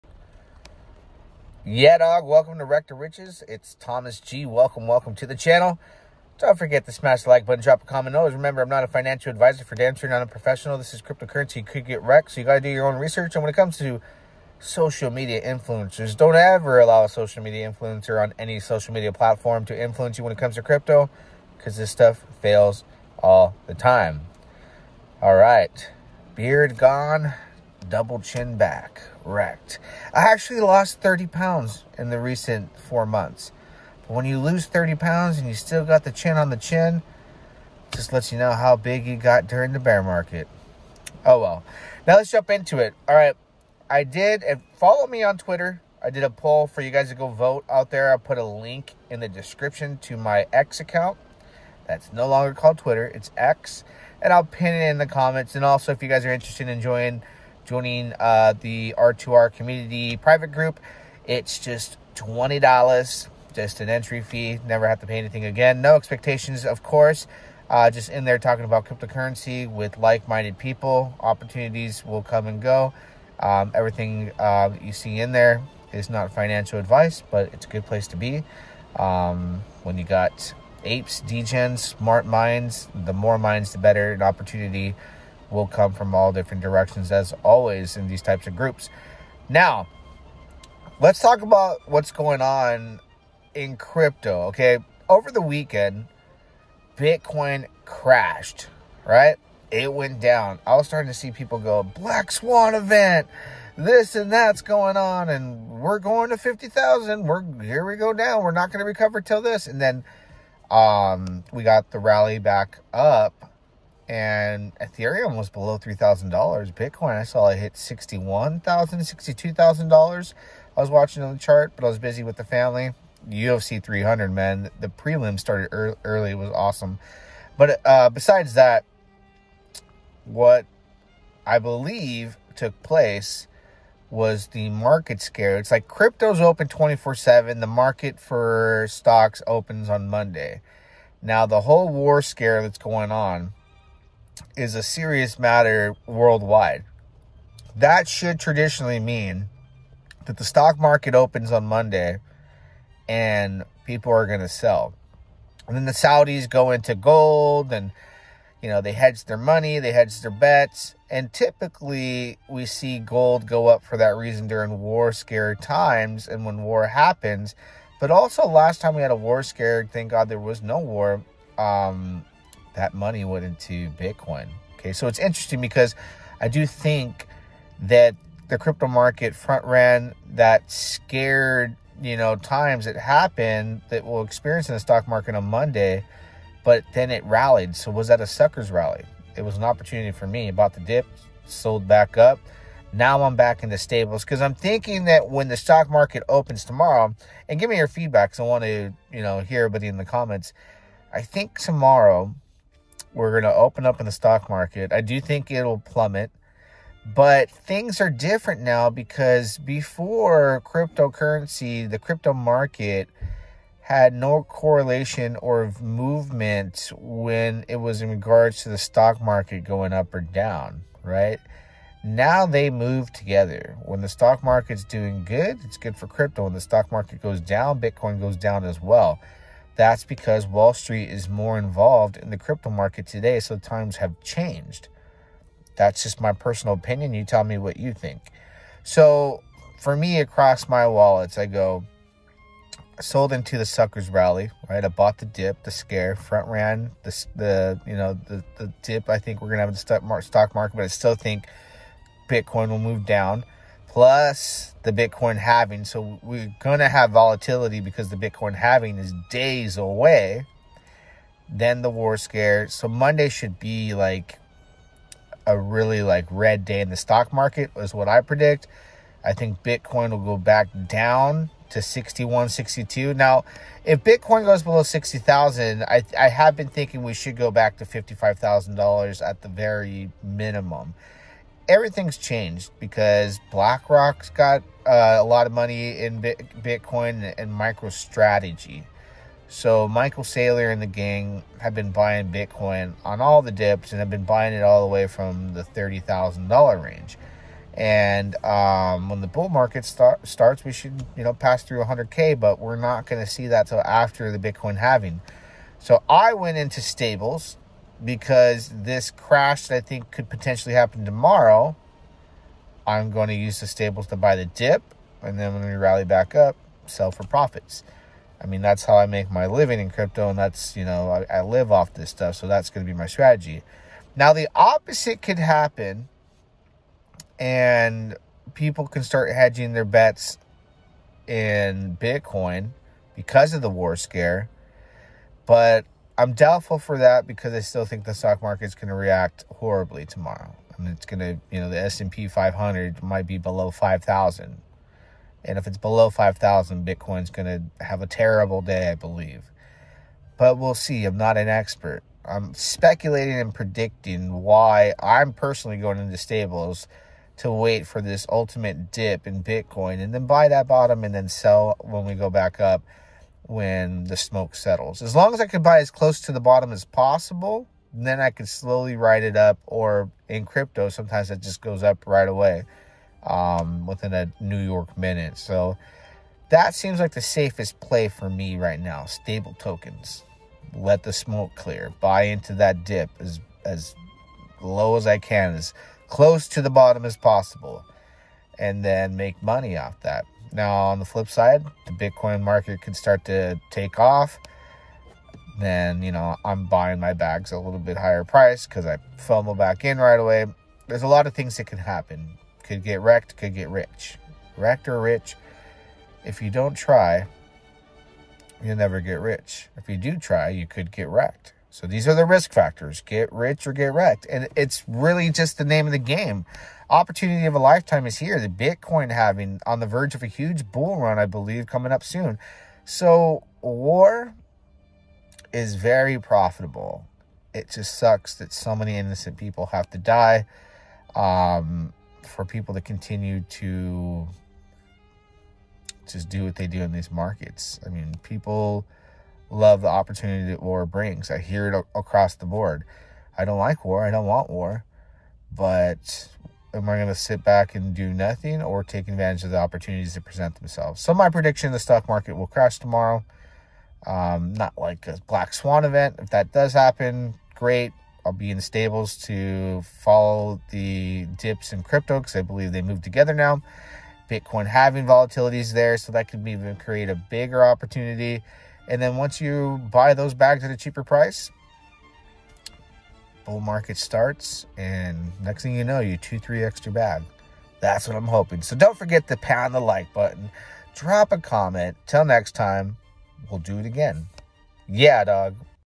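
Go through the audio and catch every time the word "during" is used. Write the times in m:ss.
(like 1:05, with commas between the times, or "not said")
0:39, 2:44.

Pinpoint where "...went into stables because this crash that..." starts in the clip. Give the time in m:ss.
5:06.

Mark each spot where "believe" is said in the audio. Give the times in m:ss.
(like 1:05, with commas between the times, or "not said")
2:11, 5:48, 7:01, 7:42.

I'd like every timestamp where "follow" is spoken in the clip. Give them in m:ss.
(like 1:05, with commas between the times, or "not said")
0:44, 7:39.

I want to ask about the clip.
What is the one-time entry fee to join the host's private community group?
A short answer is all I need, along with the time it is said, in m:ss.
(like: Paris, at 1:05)
$20, at 1:02.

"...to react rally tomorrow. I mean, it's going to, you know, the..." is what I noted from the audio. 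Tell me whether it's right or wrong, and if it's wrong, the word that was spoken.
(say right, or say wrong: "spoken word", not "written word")
wrong: "horribly", not "rally".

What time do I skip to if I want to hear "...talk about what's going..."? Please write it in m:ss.
1:31.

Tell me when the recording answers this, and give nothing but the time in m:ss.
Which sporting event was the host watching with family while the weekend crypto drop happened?
2:03.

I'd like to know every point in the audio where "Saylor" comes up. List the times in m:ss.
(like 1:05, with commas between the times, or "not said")
4:50.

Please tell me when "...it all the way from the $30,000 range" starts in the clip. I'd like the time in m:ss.
4:54.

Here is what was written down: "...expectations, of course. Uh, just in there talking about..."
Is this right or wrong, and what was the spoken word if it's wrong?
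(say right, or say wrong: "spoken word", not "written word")
right.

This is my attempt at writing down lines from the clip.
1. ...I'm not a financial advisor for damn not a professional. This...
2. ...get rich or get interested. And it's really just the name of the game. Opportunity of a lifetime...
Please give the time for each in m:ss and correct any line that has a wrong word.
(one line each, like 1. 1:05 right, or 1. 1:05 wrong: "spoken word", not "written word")
1. 0:08 right
2. 6:53 wrong: "wrecked", not "interested".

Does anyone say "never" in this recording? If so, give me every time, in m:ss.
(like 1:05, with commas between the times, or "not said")
1:04, 6:48.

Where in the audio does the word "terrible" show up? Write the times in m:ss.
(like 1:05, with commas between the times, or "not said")
5:48.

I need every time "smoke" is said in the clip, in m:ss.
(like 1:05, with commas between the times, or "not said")
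6:04, 6:21.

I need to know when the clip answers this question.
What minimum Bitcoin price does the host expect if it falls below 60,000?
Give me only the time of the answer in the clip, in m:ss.
4:37.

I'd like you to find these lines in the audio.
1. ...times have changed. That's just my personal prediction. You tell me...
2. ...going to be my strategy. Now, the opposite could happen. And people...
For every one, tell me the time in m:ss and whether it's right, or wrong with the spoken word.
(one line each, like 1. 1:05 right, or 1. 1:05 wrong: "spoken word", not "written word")
1. 3:53 wrong: "opinion", not "prediction"
2. 5:22 right.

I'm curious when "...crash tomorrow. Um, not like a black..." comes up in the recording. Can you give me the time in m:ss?
7:32.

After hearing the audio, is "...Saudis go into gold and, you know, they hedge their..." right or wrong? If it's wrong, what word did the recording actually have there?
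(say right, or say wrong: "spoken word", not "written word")
right.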